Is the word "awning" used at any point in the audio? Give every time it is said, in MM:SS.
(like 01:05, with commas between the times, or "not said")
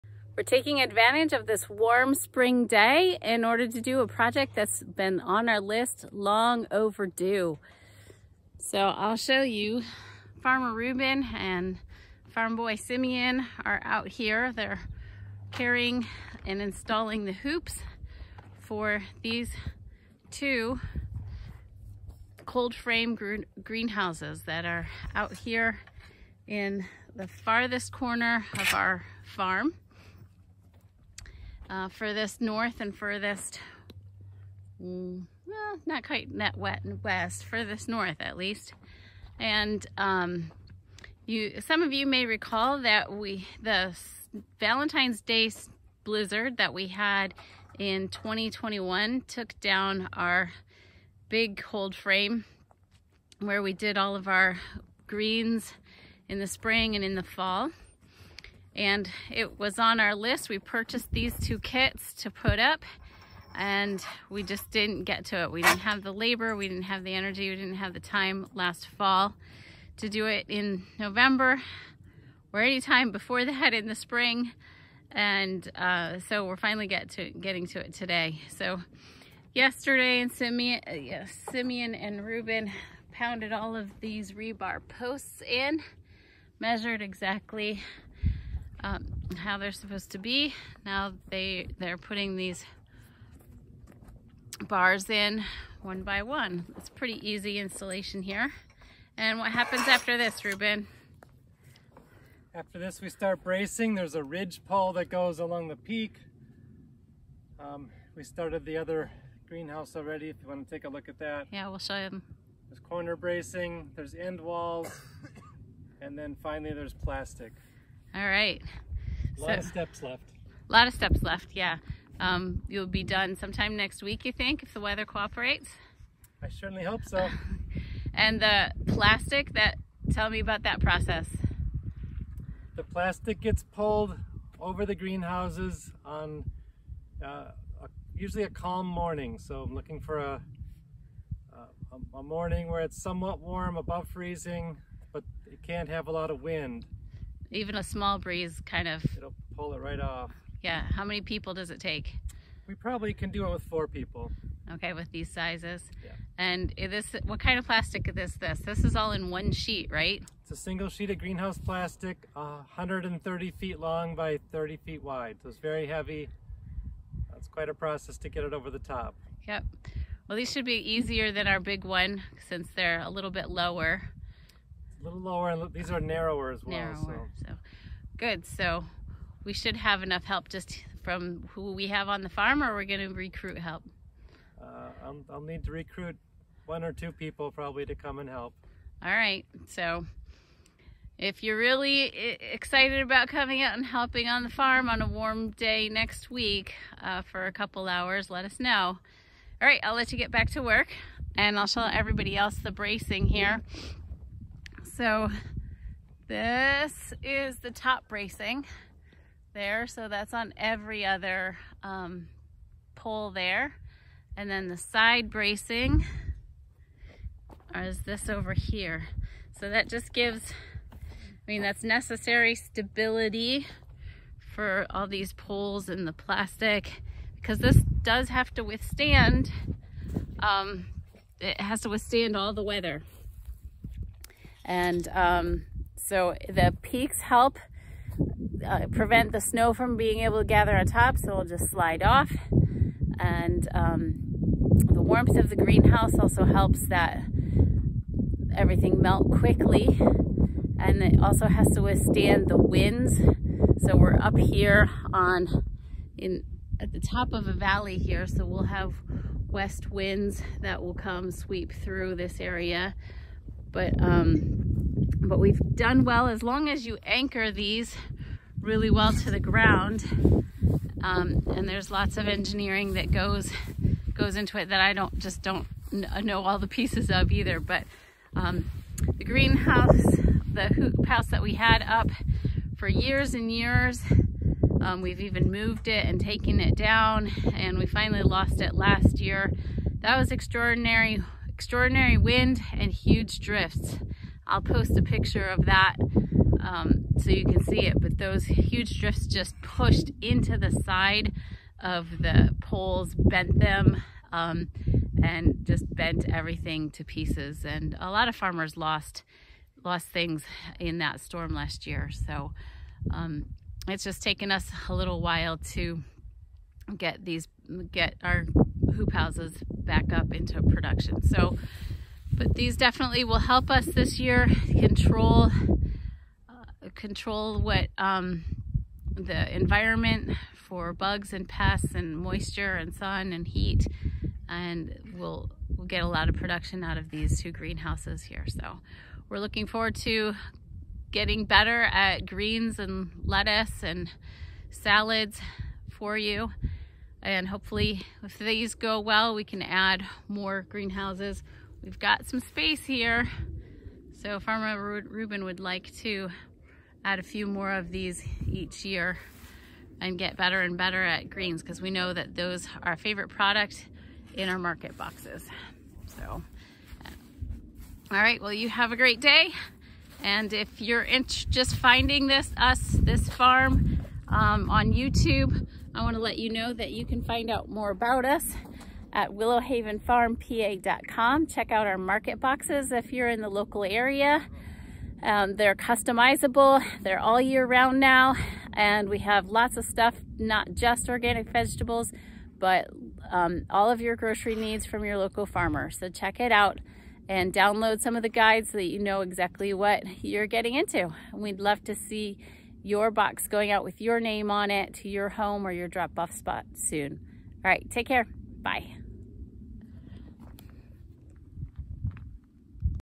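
not said.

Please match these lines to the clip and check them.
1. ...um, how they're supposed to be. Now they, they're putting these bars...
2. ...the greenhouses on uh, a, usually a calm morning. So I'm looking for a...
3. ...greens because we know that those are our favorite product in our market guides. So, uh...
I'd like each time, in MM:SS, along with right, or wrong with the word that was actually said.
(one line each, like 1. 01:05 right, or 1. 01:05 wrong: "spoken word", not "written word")
1. 01:28 right
2. 02:14 right
3. 06:01 wrong: "boxes", not "guides".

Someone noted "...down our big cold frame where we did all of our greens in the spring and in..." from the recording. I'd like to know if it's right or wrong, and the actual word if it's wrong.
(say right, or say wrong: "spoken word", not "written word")
right.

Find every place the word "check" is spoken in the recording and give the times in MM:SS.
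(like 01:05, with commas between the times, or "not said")
06:21, 06:36.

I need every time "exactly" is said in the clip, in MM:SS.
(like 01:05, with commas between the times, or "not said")
01:27, 06:39.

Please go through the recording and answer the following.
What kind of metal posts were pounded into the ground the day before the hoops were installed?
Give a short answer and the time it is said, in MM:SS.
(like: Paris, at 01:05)
rebar, at 01:24.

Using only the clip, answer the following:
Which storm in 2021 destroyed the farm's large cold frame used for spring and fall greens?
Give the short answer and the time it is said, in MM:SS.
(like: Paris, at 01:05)
Valentine's Day blizzard, at 00:44.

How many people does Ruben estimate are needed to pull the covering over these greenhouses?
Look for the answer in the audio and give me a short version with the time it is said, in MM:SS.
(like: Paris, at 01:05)
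4, at 02:33.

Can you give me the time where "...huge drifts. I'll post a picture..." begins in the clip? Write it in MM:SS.
04:52.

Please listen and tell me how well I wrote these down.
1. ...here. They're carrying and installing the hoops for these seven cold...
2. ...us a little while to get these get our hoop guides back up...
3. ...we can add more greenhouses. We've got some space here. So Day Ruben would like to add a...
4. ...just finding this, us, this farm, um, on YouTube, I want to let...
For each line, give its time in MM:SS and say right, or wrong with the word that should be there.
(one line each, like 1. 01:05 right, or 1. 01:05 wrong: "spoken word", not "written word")
1. 00:14 wrong: "two", not "seven"
2. 05:14 wrong: "houses", not "guides"
3. 05:49 wrong: "Farmer", not "Day"
4. 06:11 right.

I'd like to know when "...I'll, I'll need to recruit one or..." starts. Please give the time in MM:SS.
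03:05.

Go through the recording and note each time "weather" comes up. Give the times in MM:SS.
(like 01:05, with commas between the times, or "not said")
02:04, 03:52.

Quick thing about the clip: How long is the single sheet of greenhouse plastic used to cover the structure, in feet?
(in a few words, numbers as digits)
130 feet.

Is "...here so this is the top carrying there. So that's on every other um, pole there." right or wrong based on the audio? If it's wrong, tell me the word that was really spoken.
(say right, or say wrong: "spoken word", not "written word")
wrong: "bracing", not "carrying".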